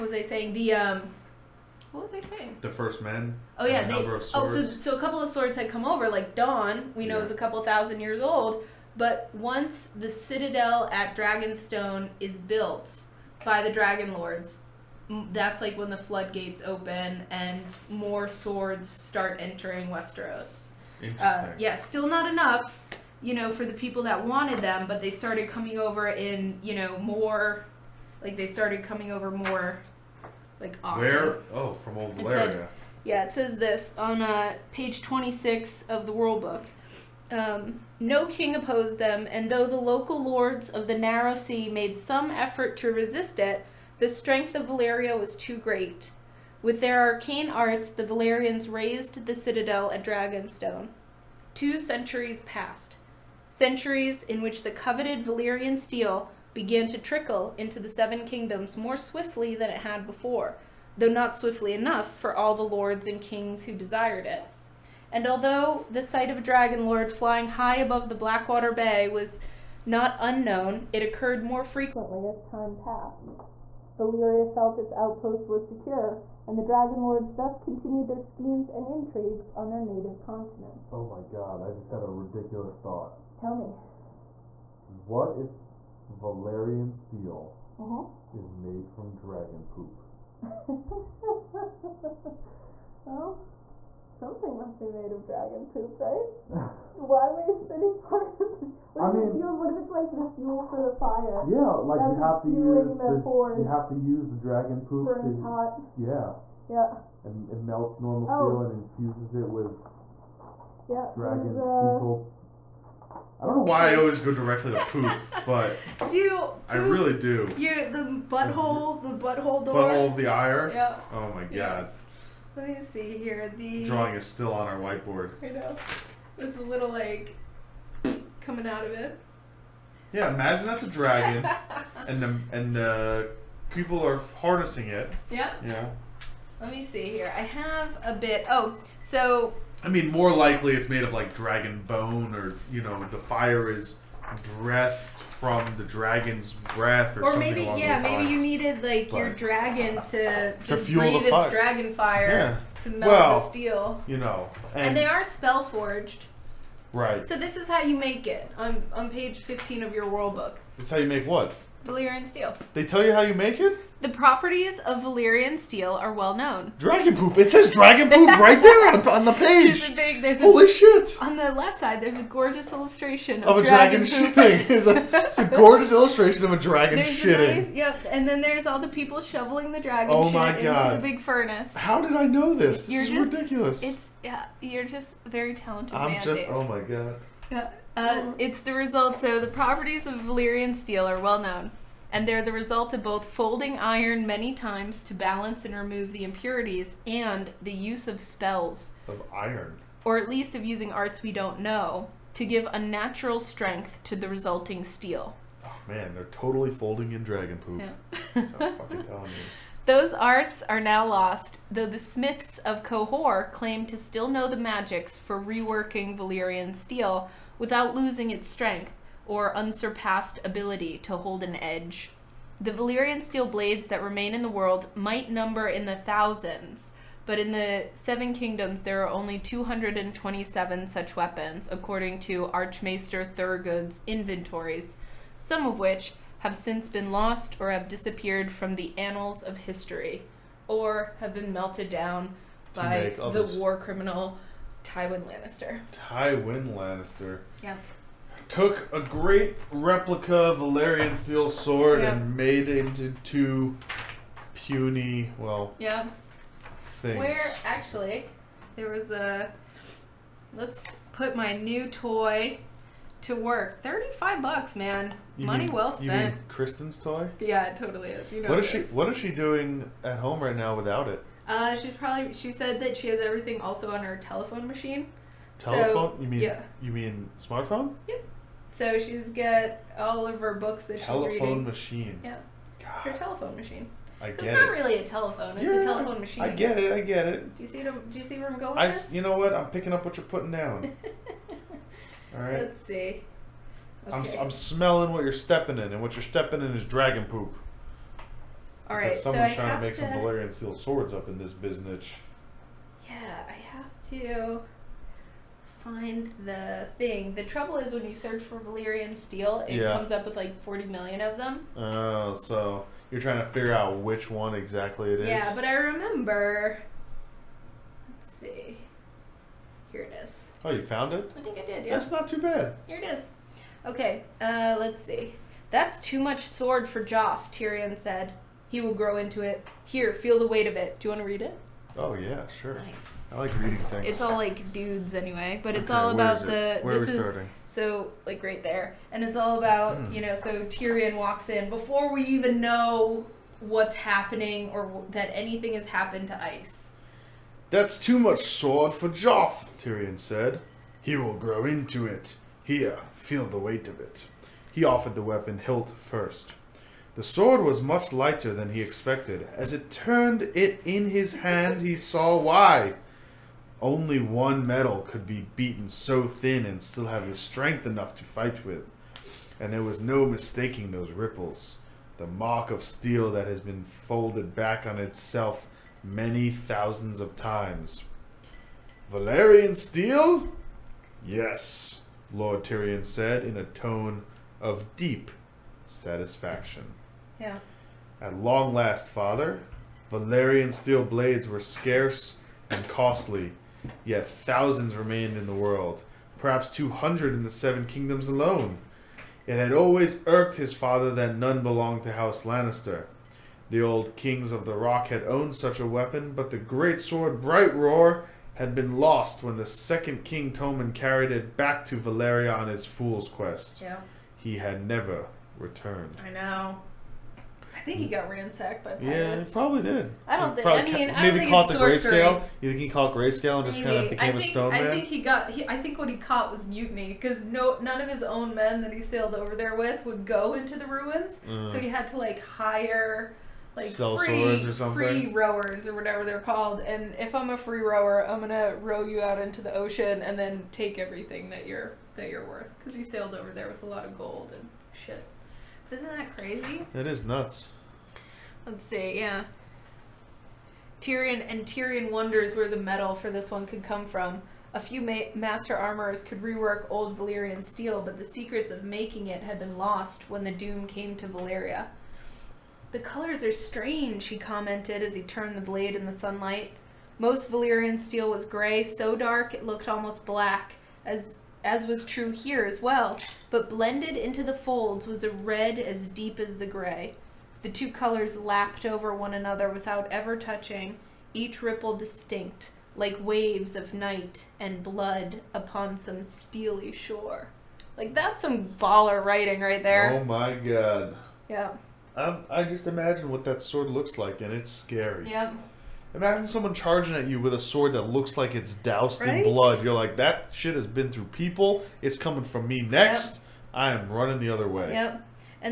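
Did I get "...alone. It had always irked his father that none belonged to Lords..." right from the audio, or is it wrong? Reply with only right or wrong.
wrong.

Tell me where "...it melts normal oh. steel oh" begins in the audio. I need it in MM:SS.
01:47.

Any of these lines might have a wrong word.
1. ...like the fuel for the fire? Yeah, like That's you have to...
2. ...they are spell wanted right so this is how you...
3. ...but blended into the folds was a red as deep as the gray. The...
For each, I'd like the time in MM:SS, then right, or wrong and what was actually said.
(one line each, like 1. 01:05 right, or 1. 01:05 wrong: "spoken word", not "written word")
1. 01:39 right
2. 02:34 wrong: "forged", not "wanted"
3. 07:53 right.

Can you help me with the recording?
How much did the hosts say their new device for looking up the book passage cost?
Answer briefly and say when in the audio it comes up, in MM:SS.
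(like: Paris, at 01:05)
35 dollars, at 04:23.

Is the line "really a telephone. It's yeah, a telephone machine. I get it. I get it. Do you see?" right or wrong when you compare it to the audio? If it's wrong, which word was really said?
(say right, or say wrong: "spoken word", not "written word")
right.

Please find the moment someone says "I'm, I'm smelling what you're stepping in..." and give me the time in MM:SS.
04:54.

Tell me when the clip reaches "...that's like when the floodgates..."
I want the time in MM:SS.
00:15.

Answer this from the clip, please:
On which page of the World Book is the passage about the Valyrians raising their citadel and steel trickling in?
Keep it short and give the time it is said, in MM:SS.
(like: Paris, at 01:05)
26, at 00:35.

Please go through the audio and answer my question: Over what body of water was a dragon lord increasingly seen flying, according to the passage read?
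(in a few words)
Blackwater Bay.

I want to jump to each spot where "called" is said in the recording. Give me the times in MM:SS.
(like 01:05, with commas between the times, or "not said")
07:16.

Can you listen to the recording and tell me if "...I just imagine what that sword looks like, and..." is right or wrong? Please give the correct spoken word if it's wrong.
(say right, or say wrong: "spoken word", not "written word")
right.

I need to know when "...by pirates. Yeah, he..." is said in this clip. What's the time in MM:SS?
06:58.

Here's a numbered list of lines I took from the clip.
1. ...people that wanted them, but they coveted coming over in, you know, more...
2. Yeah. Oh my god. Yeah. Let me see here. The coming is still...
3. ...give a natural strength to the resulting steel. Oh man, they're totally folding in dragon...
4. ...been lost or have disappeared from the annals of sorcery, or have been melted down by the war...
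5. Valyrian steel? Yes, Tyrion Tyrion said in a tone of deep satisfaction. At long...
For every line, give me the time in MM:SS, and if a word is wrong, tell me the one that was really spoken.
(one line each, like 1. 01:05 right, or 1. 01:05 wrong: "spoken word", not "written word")
1. 00:23 wrong: "started", not "coveted"
2. 02:00 wrong: "drawing", not "coming"
3. 03:22 right
4. 03:56 wrong: "history", not "sorcery"
5. 06:19 wrong: "Lord", not "Tyrion".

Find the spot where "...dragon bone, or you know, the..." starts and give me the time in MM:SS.
02:21.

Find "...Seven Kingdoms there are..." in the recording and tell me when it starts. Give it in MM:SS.
03:47.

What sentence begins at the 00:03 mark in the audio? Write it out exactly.
Oh yeah, they, oh so so a couple of swords had come over.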